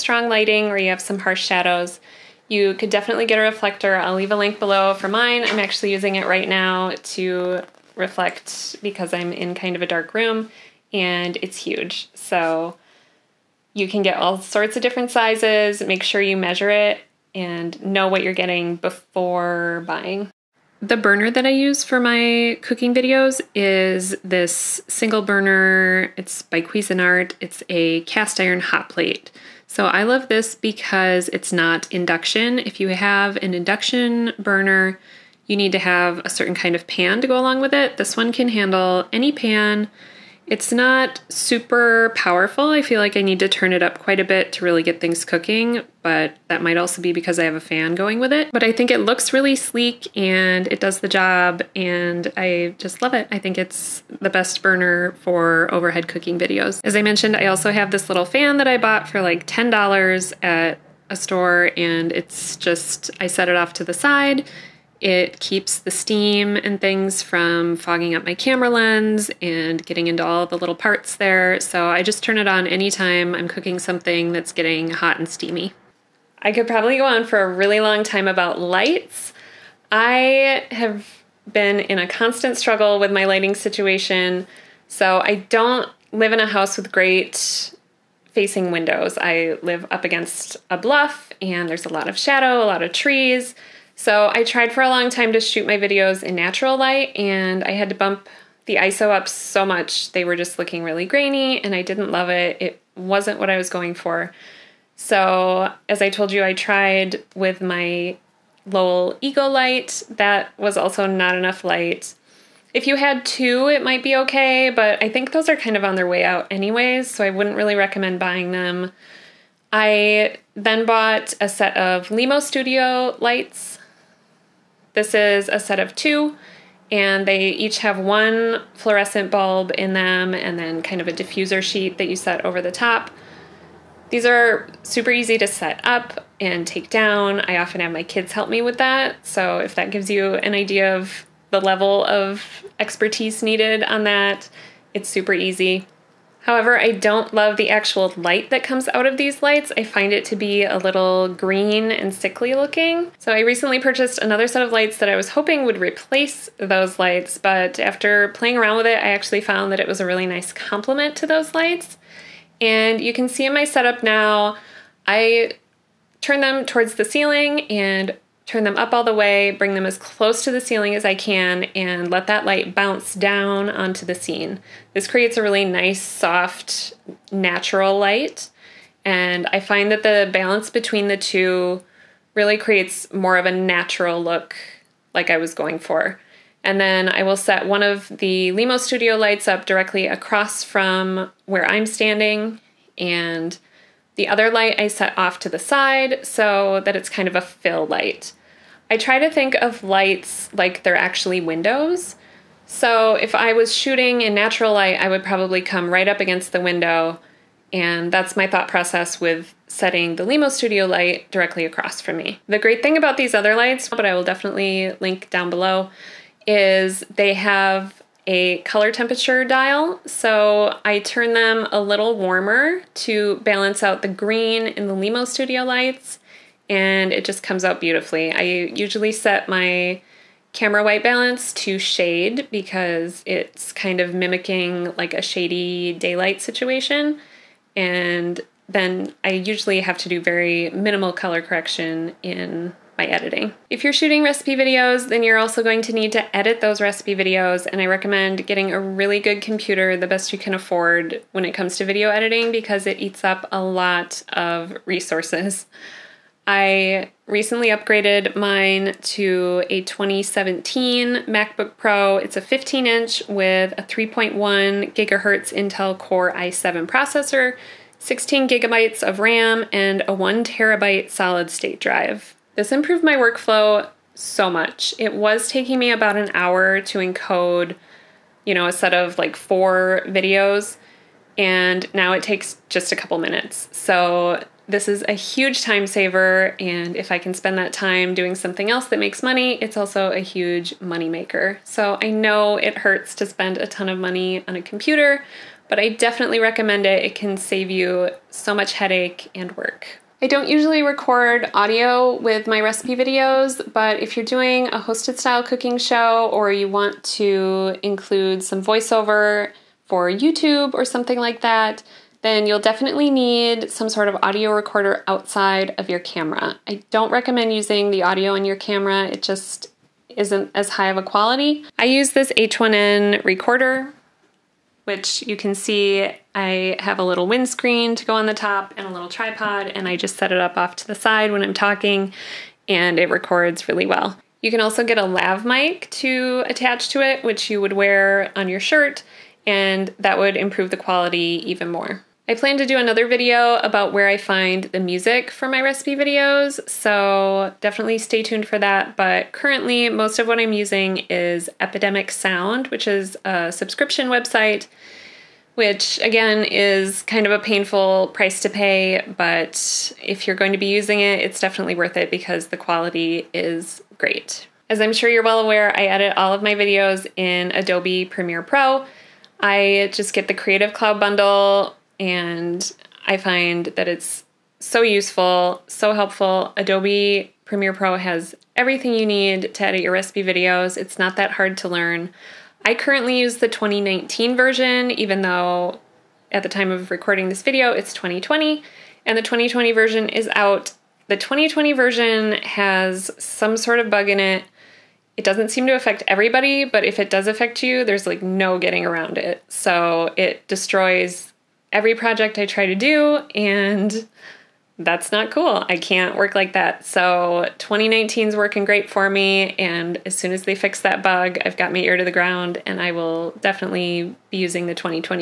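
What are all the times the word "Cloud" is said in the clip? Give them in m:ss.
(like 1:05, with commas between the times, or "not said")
6:10.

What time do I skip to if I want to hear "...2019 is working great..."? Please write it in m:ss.
6:47.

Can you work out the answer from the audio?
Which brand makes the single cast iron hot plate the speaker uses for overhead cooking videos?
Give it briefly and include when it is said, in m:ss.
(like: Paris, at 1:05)
Cuisinart, at 0:26.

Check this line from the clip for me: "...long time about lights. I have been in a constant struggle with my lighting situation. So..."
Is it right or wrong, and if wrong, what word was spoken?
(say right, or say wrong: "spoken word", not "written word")
right.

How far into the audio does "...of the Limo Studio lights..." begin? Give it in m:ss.
3:07.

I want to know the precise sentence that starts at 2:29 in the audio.
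I find it to be a little green and sickly looking.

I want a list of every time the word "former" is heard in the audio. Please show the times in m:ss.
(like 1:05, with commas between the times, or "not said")
not said.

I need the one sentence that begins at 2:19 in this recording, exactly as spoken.
So if that gives you an idea of the level of expertise needed on that, it's super easy.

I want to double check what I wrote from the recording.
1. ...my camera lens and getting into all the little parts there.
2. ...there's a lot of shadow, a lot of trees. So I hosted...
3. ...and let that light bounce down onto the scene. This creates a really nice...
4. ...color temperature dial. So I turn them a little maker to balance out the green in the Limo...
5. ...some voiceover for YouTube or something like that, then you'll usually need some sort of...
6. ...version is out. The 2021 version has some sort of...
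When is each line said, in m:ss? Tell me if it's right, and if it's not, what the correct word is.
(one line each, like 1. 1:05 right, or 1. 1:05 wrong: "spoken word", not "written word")
1. 1:08 right
2. 1:31 wrong: "tried", not "hosted"
3. 2:51 right
4. 3:38 wrong: "warmer", not "maker"
5. 5:08 wrong: "definitely", not "usually"
6. 6:29 wrong: "2020", not "2021".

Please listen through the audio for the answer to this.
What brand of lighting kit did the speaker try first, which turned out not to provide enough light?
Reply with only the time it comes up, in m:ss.
1:48.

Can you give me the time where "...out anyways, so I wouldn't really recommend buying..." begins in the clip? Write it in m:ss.
1:56.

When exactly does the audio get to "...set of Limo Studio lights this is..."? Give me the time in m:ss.
2:01.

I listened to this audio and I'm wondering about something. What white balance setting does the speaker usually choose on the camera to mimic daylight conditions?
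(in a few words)
shade.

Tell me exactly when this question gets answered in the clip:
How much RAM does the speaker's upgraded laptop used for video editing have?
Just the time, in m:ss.
4:27.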